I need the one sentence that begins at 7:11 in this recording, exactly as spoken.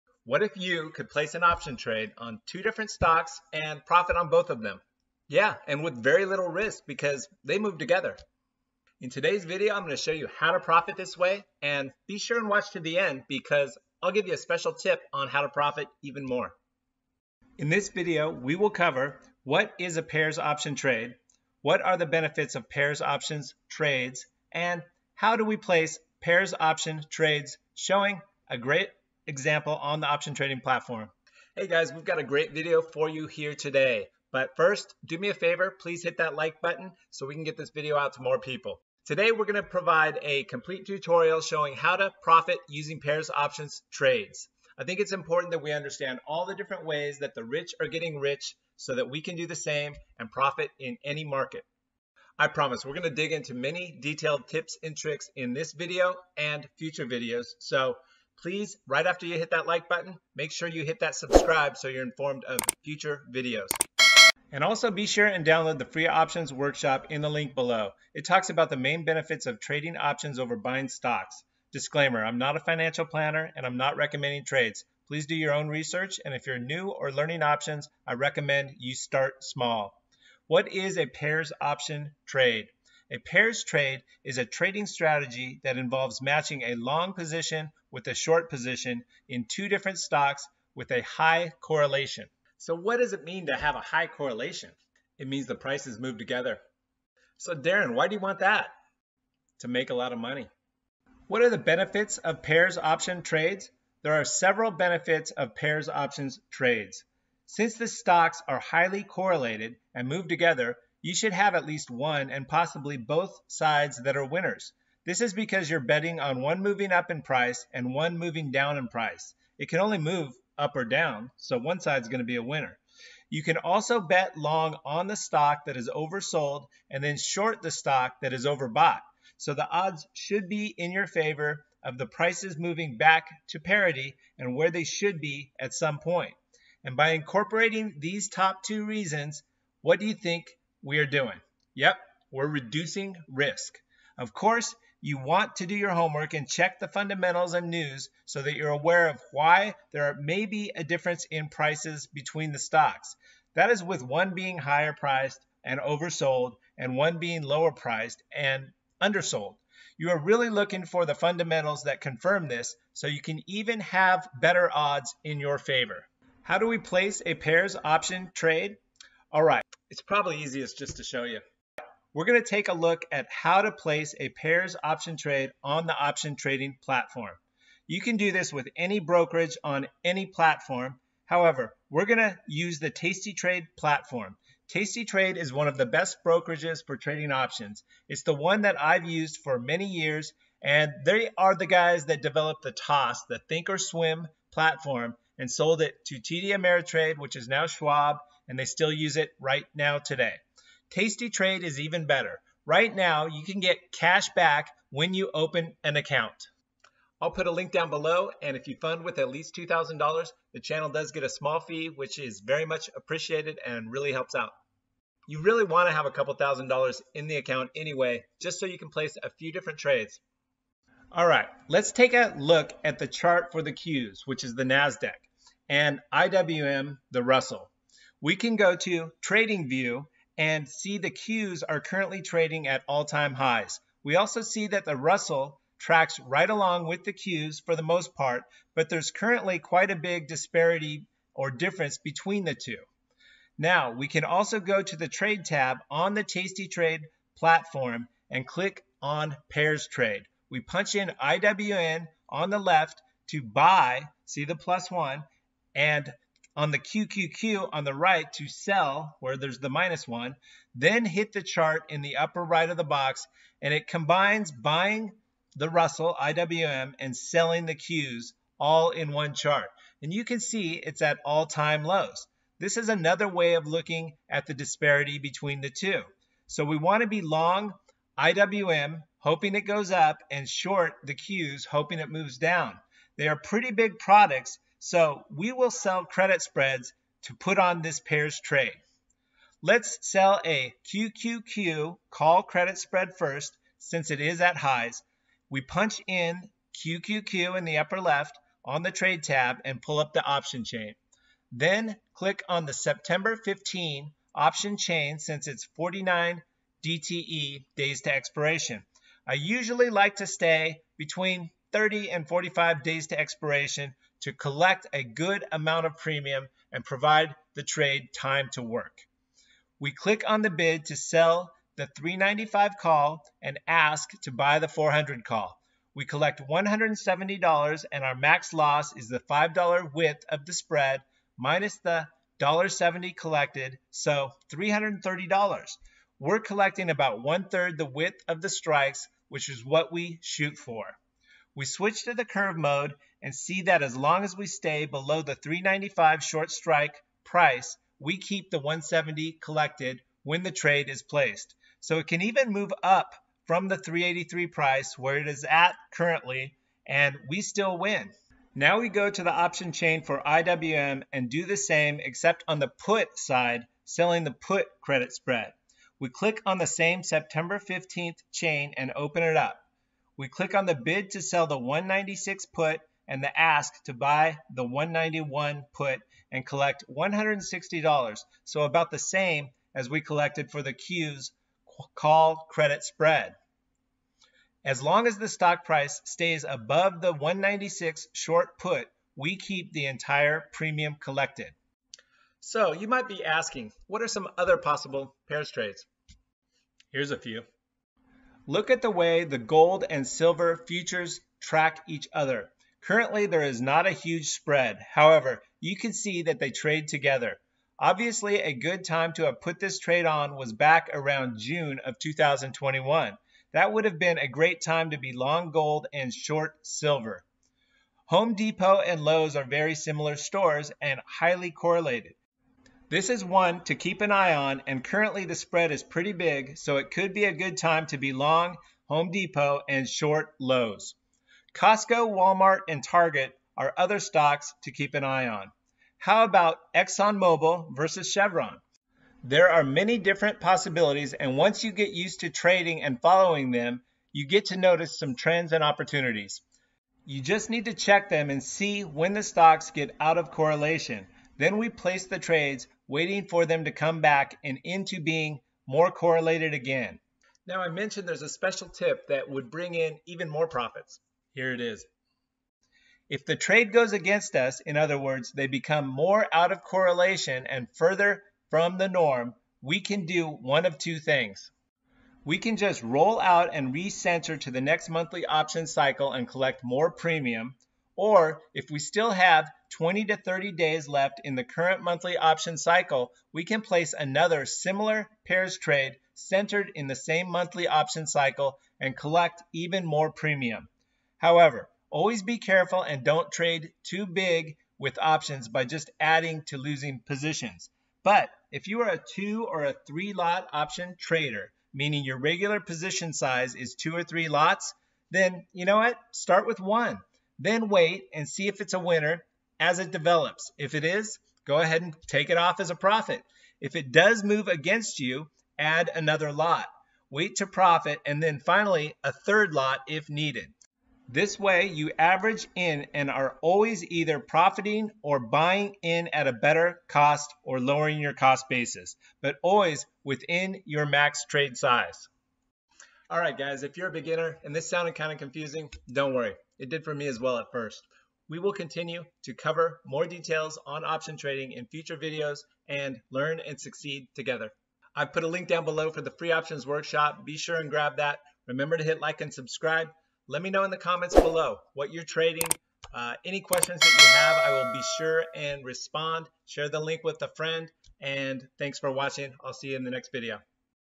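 Costco, Walmart, and Target are other stocks to keep an eye on.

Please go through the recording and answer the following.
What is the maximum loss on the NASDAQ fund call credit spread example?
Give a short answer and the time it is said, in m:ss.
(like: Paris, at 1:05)
$330, at 5:34.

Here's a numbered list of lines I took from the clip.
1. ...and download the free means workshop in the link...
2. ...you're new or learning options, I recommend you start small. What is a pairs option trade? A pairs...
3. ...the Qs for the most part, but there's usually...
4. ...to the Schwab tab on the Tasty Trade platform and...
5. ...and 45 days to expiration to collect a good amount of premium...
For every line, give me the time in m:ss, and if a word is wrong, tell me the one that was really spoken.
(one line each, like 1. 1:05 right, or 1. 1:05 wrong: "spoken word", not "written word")
1. 1:05 wrong: "options", not "means"
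2. 1:16 right
3. 3:57 wrong: "currently", not "usually"
4. 4:04 wrong: "Trade", not "Schwab"
5. 5:12 right.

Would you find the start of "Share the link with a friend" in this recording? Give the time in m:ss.
9:16.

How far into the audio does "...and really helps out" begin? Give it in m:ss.
3:33.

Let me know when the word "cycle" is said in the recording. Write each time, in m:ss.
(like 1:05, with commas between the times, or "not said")
7:55, 8:02, 8:08.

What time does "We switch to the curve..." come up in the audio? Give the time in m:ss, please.
5:41.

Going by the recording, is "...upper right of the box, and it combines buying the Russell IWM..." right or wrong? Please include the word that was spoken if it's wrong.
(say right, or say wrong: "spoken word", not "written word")
right.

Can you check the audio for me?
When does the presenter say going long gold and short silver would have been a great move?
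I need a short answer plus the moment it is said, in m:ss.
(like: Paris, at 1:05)
June 2021, at 6:51.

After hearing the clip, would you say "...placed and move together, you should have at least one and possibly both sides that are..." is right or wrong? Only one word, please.
wrong.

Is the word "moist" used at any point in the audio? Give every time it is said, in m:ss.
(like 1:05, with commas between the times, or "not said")
not said.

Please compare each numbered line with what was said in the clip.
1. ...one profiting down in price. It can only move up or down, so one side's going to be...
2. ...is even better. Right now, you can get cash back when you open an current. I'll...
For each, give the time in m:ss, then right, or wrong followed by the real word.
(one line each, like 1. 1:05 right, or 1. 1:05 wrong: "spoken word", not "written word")
1. 1:57 wrong: "moving", not "profiting"
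2. 3:21 wrong: "account", not "current".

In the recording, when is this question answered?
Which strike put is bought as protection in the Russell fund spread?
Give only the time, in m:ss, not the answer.
6:14.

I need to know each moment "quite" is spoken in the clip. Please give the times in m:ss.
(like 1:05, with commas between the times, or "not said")
3:59.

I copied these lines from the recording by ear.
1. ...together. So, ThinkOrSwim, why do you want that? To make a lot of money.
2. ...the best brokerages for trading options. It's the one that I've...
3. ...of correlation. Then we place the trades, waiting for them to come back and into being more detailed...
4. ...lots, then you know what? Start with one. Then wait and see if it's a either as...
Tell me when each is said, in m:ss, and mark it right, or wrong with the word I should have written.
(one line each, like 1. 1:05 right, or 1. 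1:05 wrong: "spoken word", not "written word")
1. 1:36 wrong: "Darren", not "ThinkOrSwim"
2. 3:05 right
3. 7:30 wrong: "correlated", not "detailed"
4. 8:24 wrong: "winner", not "either".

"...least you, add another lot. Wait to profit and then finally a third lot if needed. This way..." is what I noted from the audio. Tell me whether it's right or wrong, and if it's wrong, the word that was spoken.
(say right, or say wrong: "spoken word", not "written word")
wrong: "against", not "least".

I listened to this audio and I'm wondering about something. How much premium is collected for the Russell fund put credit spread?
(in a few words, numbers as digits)
$160.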